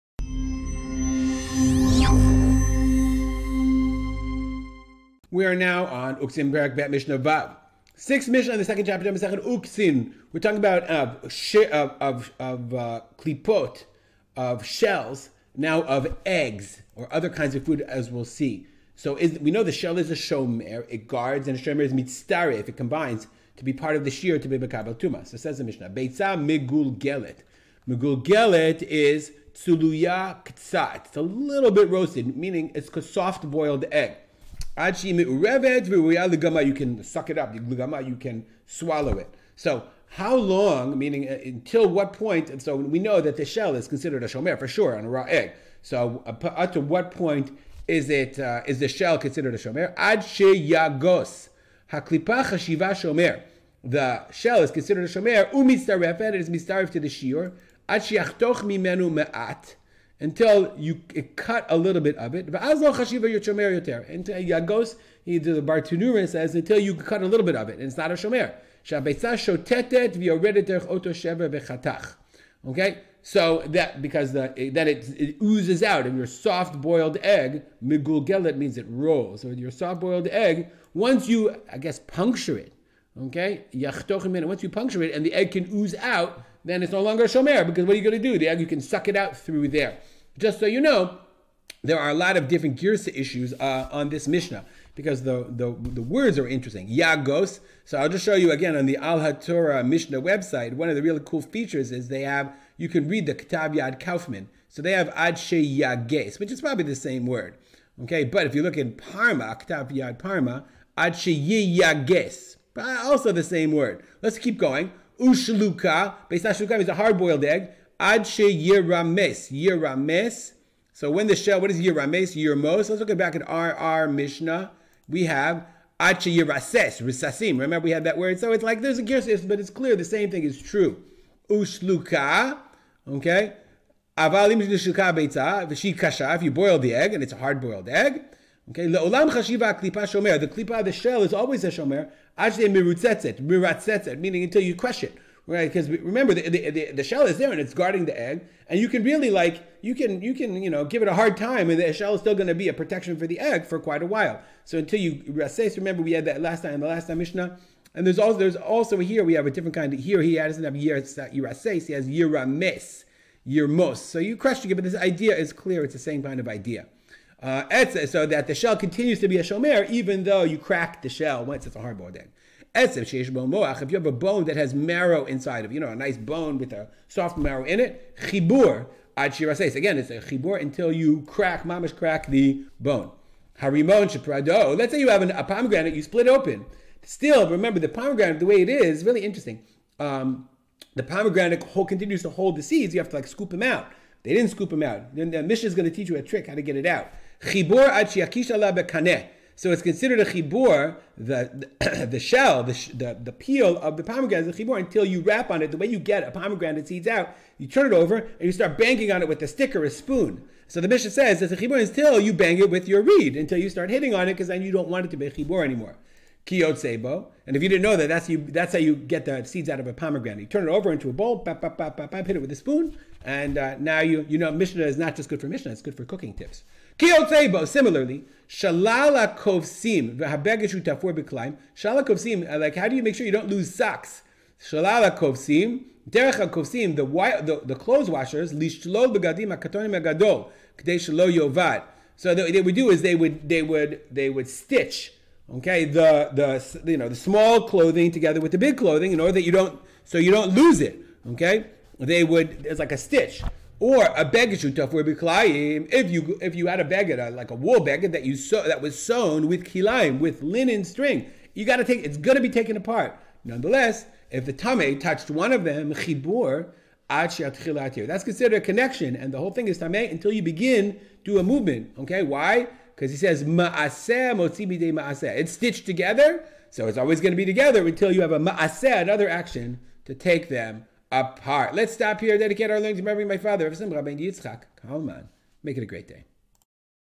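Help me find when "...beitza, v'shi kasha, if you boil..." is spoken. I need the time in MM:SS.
02:15.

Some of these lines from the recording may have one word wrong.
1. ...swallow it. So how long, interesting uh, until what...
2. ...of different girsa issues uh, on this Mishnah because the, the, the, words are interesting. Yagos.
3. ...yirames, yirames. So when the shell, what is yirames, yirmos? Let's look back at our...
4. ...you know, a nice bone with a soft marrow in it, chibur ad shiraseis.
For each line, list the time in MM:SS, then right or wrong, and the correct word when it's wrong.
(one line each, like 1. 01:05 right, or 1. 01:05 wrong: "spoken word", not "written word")
1. 00:38 wrong: "meaning", not "interesting"
2. 01:32 right
3. 01:58 right
4. 02:55 right.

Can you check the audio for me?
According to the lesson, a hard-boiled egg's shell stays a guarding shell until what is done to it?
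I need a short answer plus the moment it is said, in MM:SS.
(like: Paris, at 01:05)
Until you crush it, at 02:24.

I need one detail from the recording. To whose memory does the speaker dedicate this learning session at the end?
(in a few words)
Yitzchak Kalman.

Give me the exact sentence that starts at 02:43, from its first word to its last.
So you crush, it, but this idea is clear.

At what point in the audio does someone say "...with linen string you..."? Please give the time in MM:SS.
04:20.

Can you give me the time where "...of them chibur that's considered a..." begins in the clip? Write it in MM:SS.
04:25.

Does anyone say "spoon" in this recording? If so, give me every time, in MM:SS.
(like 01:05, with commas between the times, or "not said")
03:29, 03:42.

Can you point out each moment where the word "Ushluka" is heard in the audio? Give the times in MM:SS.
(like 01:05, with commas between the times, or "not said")
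01:55, 02:11.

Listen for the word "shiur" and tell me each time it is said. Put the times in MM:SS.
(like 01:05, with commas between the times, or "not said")
00:57.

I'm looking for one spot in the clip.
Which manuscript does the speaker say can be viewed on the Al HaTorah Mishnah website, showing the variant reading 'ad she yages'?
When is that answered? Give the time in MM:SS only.
01:43.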